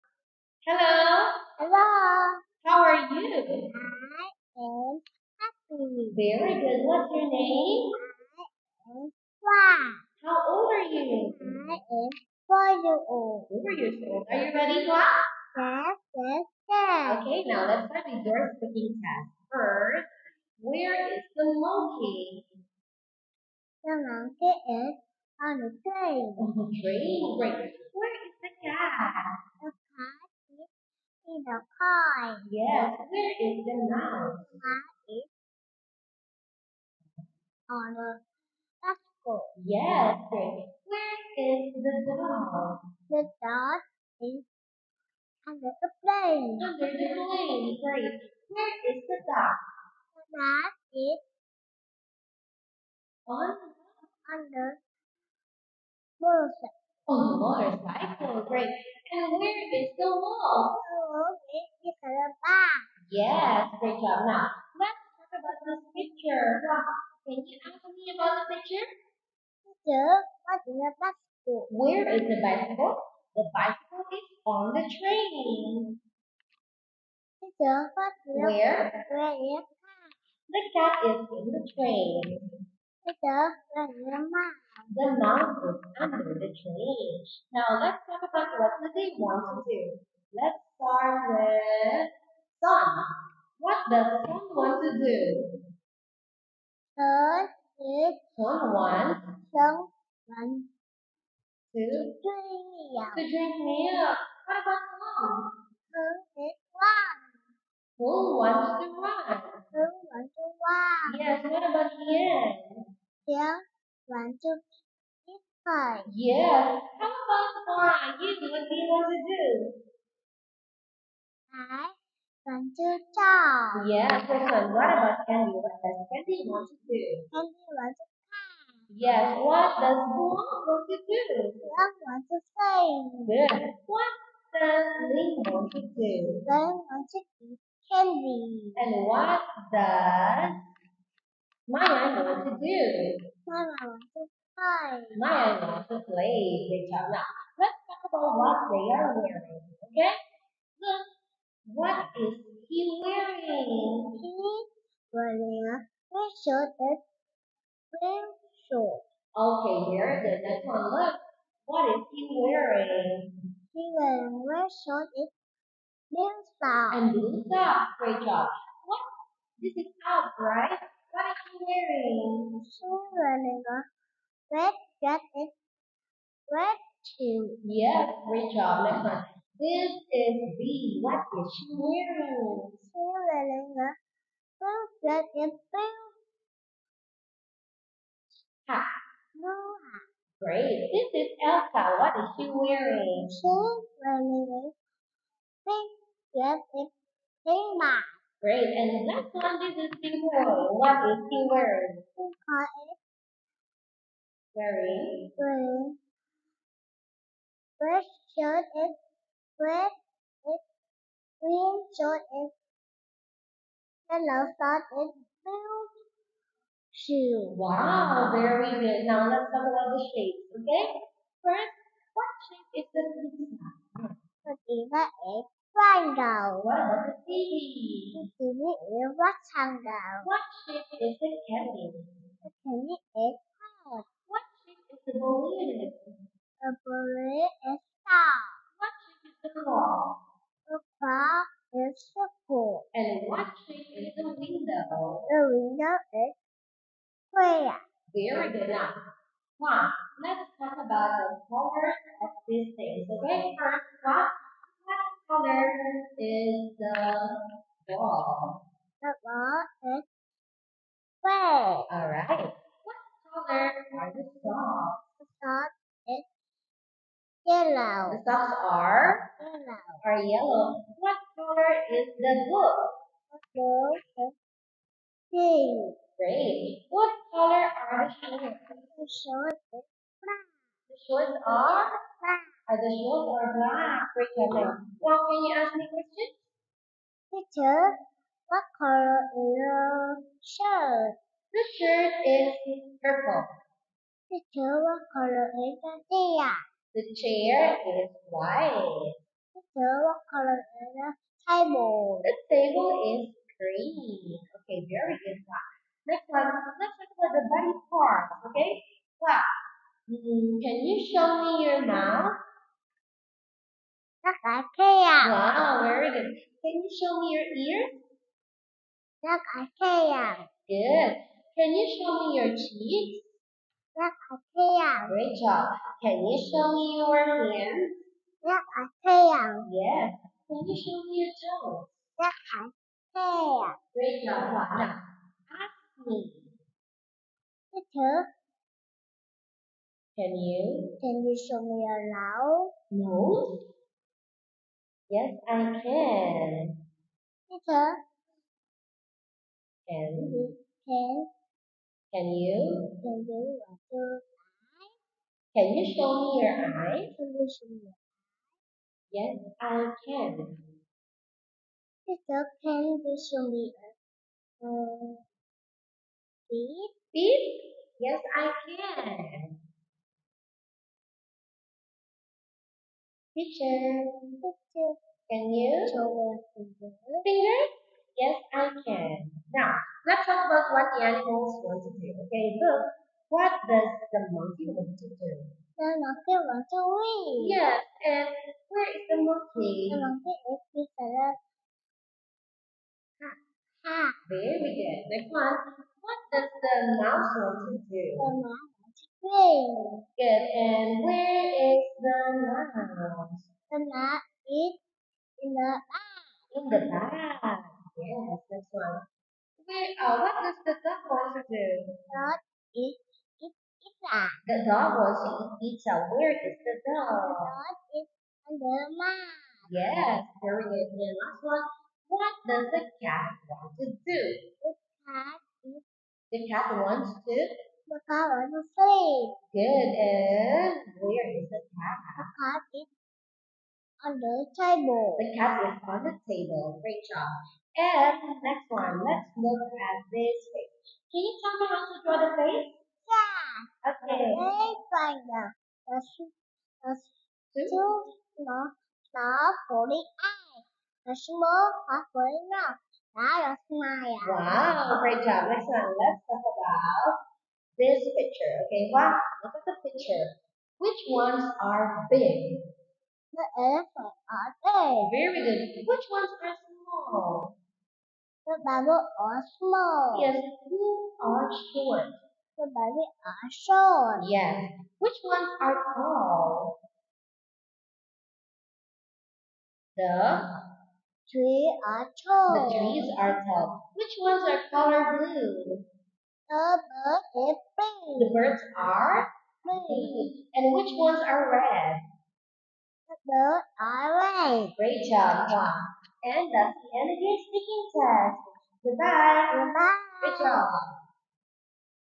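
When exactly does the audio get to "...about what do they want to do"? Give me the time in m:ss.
1:28.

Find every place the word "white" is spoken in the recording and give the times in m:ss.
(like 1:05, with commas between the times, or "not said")
4:58.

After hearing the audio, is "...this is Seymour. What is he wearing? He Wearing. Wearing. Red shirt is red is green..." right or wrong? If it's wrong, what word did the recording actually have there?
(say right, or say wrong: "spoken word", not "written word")
right.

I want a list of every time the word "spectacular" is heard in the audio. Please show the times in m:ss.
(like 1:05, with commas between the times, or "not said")
not said.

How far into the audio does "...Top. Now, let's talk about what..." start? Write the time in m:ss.
2:26.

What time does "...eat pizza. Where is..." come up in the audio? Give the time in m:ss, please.
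6:55.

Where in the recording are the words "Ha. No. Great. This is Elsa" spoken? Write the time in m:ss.
3:08.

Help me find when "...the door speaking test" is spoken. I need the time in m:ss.
0:18.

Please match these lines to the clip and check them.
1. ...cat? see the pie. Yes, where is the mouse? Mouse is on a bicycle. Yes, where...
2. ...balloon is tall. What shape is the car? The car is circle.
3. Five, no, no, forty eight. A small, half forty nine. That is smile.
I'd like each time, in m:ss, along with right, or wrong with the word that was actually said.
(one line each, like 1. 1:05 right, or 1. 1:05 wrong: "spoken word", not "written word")
1. 0:28 right
2. 3:56 right
3. 7:27 wrong: "Two", not "Five".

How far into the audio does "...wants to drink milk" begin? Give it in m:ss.
1:40.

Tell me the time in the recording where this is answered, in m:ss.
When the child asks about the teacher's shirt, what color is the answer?
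4:51.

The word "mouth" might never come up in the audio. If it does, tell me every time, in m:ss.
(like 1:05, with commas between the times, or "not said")
5:11.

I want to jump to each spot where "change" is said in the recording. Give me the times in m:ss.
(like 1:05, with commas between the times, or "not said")
1:26.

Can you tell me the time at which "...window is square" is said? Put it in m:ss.
4:05.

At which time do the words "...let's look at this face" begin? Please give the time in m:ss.
7:19.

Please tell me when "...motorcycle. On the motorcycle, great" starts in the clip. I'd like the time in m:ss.
0:56.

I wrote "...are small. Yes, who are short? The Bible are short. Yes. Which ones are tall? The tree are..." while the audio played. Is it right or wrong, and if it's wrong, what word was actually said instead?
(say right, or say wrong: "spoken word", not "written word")
right.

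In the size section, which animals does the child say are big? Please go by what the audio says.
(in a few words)
elephants.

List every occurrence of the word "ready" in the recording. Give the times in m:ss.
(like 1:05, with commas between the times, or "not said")
0:14.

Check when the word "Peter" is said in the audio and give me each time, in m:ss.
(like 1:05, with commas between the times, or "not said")
5:37, 5:47.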